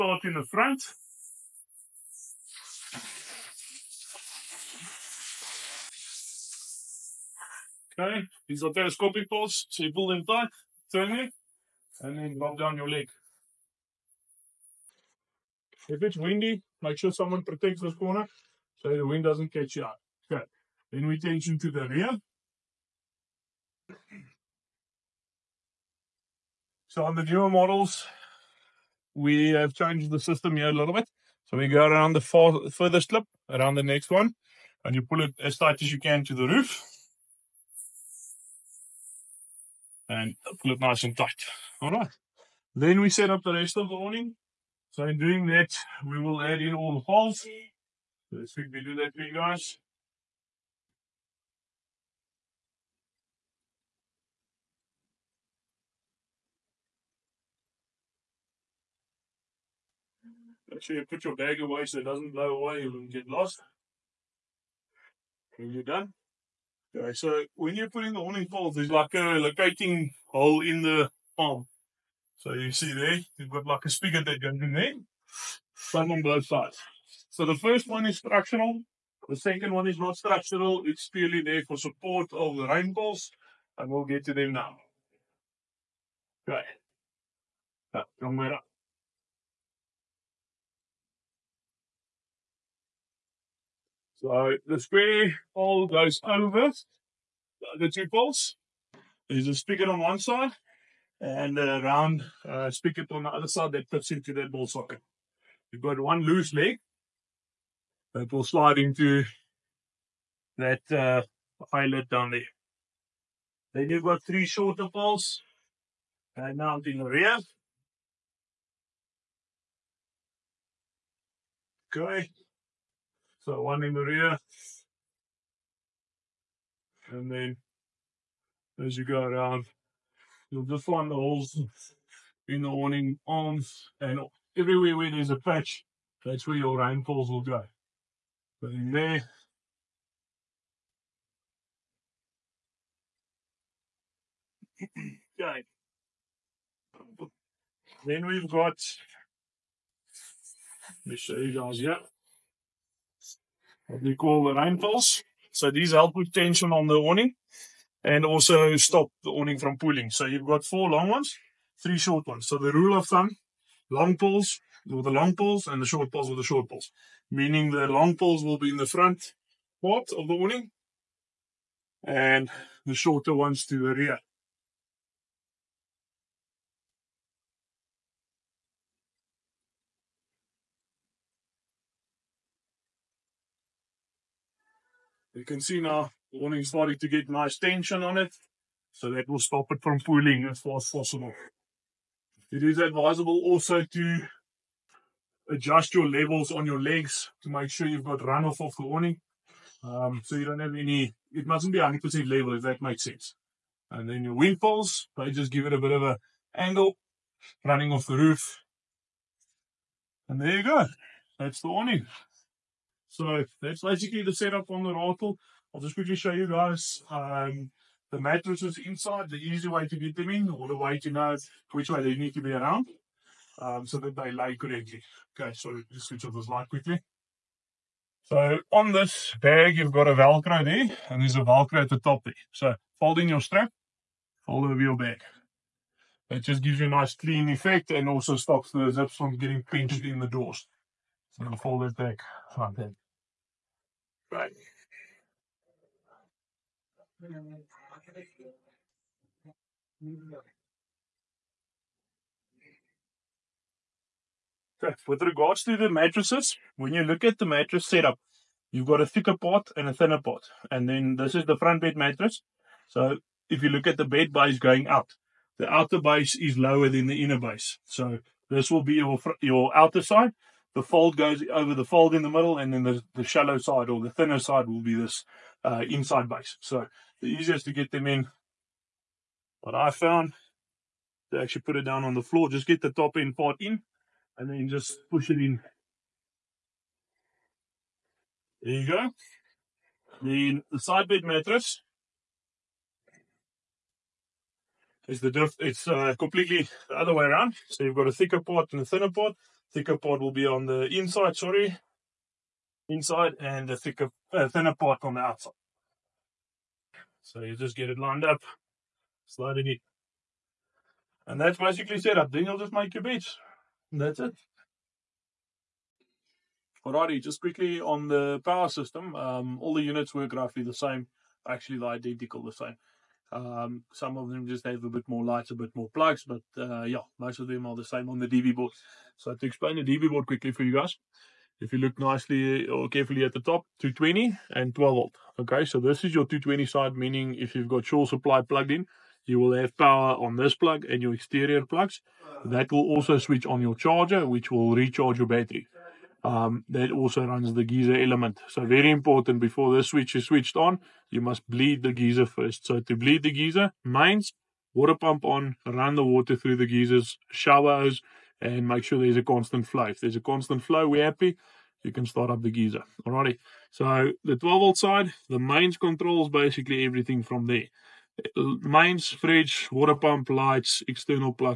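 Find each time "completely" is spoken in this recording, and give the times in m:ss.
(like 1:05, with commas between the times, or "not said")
4:56.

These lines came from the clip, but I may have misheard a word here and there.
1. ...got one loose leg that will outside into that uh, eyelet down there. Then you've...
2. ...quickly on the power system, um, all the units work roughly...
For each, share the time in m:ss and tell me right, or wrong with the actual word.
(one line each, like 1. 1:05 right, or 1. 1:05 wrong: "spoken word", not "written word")
1. 1:45 wrong: "slide", not "outside"
2. 5:17 right.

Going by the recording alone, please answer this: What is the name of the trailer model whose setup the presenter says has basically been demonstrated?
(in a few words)
Ratel.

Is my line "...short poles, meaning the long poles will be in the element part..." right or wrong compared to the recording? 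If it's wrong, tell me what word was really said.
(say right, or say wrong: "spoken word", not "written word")
wrong: "front", not "element".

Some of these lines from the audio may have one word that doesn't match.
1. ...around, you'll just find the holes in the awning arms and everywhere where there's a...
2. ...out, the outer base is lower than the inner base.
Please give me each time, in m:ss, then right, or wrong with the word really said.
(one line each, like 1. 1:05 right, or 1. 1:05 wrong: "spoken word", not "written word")
1. 2:09 right
2. 4:24 right.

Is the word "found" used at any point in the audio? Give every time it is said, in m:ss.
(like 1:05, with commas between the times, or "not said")
4:39.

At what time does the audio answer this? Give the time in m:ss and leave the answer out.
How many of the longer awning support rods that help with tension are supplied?
2:40.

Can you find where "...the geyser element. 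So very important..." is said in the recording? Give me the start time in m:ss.
5:47.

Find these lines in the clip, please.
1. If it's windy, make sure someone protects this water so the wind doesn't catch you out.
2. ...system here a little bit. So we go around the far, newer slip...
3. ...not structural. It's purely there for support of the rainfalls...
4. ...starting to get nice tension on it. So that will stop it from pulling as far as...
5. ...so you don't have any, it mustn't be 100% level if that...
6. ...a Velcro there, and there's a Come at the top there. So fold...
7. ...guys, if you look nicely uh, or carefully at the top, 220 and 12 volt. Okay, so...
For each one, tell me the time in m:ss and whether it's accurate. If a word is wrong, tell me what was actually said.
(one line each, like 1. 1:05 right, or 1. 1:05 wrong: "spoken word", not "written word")
1. 0:15 wrong: "corner", not "water"
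2. 0:30 wrong: "further", not "newer"
3. 1:19 right
4. 3:06 right
5. 3:20 right
6. 3:50 wrong: "Velcro", not "Come"
7. 5:30 right.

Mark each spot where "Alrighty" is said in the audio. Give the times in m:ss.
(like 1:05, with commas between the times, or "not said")
5:16, 6:03.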